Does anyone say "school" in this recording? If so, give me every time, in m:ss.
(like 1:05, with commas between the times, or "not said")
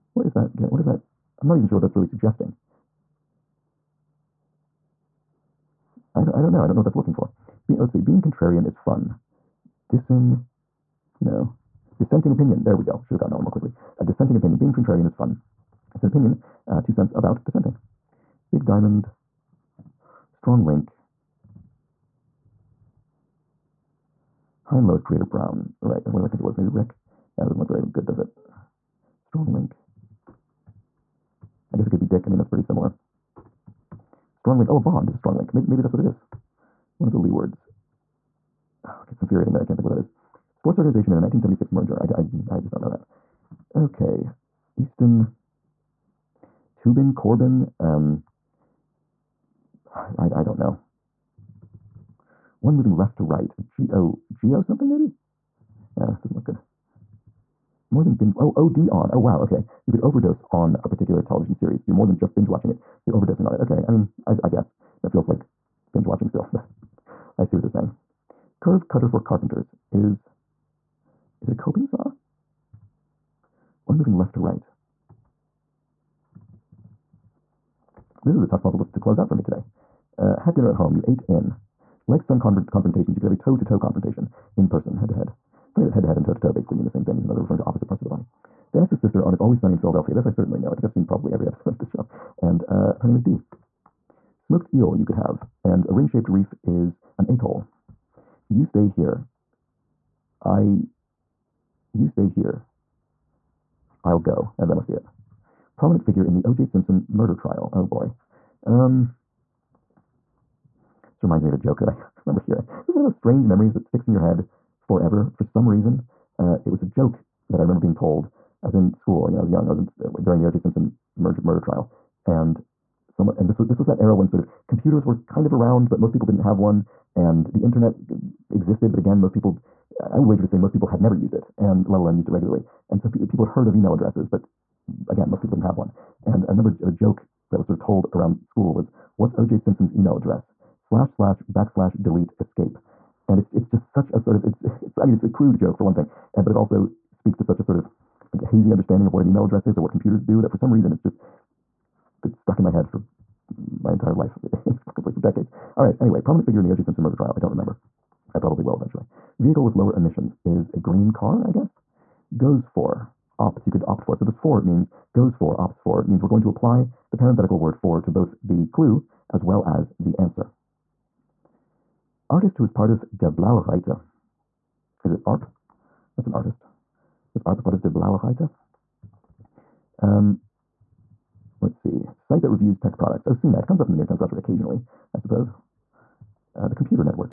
1:58, 2:18.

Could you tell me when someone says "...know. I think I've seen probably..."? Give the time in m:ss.
1:30.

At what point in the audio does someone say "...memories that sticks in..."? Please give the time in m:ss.
1:53.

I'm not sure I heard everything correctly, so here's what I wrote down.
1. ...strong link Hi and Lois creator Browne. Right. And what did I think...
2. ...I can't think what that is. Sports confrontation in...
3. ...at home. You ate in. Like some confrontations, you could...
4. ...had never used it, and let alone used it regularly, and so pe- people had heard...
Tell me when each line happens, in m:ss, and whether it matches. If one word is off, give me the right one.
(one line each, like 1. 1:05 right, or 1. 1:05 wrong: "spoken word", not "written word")
1. 0:20 right
2. 0:39 wrong: "organization", not "confrontation"
3. 1:20 right
4. 2:10 right.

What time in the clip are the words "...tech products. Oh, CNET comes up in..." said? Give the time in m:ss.
3:02.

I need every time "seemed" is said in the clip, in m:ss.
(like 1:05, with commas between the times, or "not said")
not said.